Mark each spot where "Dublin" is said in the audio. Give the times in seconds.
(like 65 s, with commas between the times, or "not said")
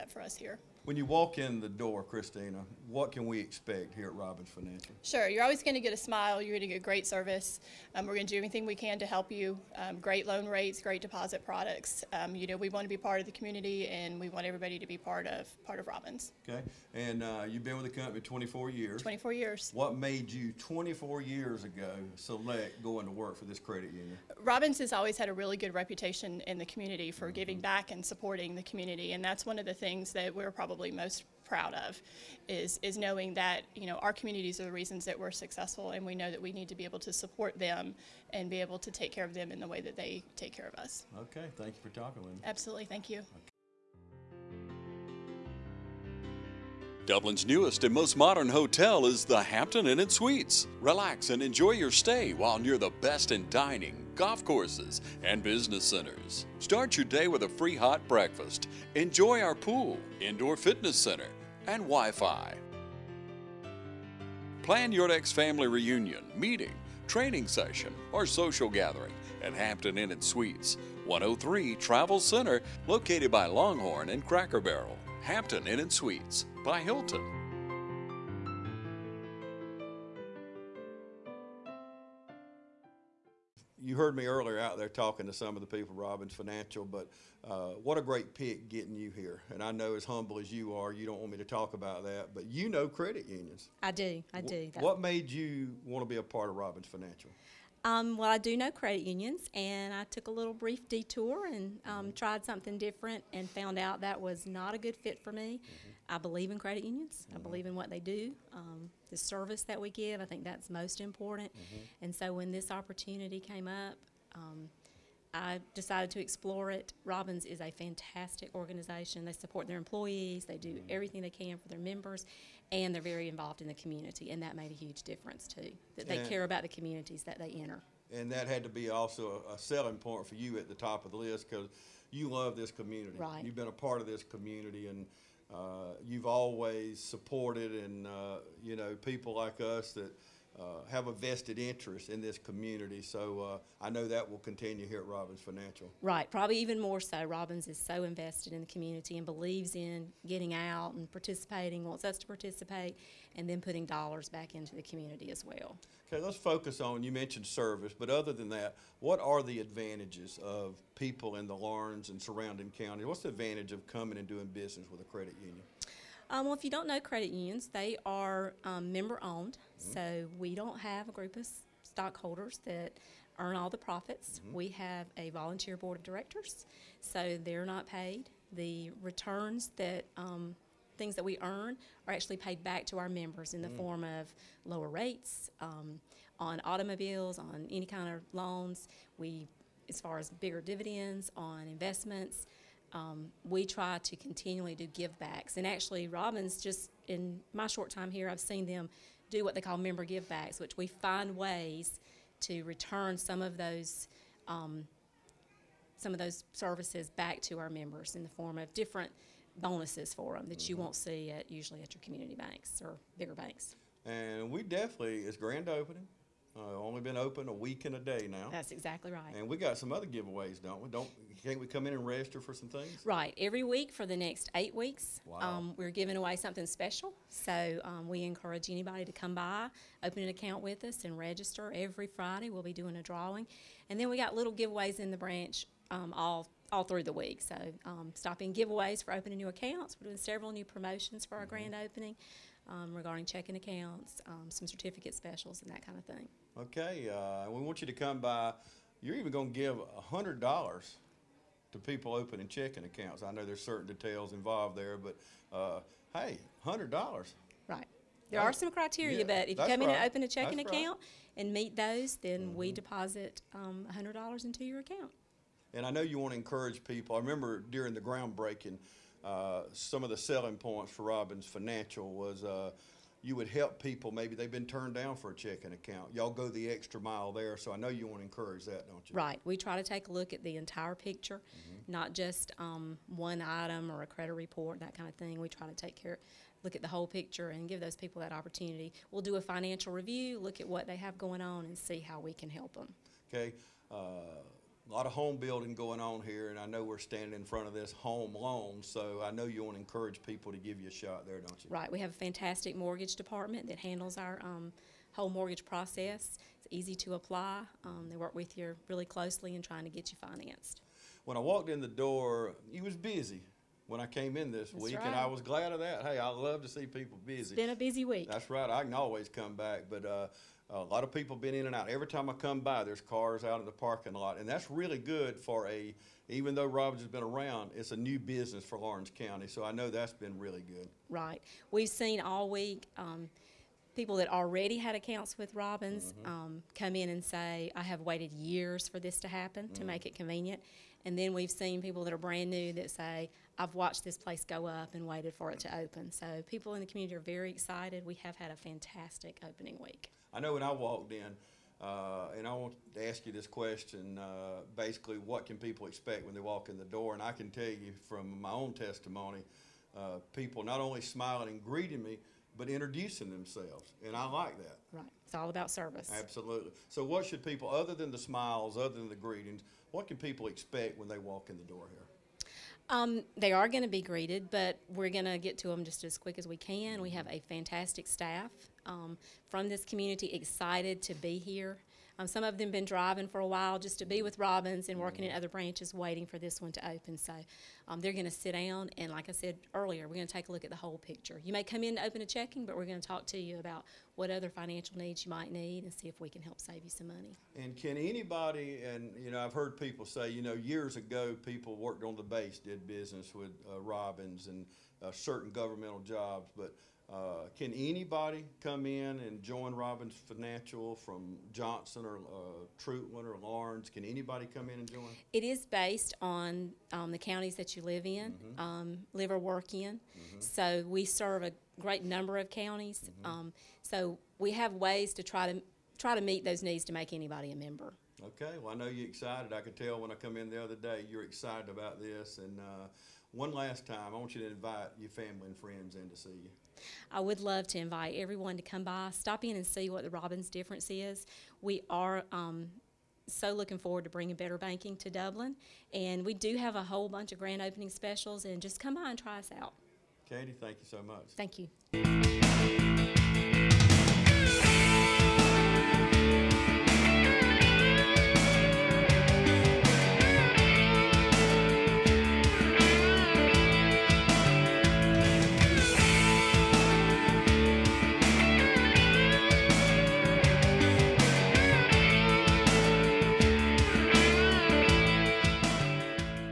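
47 s, 445 s.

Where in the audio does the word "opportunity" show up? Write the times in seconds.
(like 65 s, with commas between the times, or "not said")
112 s, 288 s.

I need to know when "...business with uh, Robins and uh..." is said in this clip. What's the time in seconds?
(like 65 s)
402 s.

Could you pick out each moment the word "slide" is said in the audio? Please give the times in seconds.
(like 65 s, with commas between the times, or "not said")
not said.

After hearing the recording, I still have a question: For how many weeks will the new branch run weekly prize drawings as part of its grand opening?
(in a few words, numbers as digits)
8.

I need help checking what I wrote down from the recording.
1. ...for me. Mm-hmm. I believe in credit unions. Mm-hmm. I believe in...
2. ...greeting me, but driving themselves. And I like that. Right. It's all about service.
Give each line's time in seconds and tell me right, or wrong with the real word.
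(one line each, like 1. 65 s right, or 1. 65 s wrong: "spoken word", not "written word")
1. 105 s right
2. 361 s wrong: "introducing", not "driving".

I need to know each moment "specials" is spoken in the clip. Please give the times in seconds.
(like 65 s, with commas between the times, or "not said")
226 s, 245 s, 447 s.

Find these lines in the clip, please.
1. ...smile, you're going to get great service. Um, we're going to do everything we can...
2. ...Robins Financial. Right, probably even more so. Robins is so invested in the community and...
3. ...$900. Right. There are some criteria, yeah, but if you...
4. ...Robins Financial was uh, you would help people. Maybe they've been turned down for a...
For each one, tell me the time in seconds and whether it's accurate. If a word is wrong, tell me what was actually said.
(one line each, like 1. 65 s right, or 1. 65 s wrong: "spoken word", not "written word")
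1. 5 s right
2. 145 s right
3. 256 s wrong: "100", not "900"
4. 271 s right.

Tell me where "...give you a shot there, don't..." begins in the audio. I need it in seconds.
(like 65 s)
300 s.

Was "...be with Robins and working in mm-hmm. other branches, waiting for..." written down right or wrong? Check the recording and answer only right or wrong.
right.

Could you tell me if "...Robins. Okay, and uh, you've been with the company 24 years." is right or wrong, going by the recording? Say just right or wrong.
right.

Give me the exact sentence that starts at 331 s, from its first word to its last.
Right, we've seen all week um, people that already had accounts with Robins mm -hmm.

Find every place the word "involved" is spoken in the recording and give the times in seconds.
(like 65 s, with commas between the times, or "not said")
123 s, 254 s.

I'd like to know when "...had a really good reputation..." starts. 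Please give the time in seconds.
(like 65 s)
25 s.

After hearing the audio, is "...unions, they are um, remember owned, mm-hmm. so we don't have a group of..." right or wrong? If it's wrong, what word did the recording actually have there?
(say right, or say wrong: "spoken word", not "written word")
wrong: "member", not "remember".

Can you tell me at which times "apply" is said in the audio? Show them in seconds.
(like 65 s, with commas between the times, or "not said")
307 s.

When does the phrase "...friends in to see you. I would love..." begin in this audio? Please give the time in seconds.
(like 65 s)
435 s.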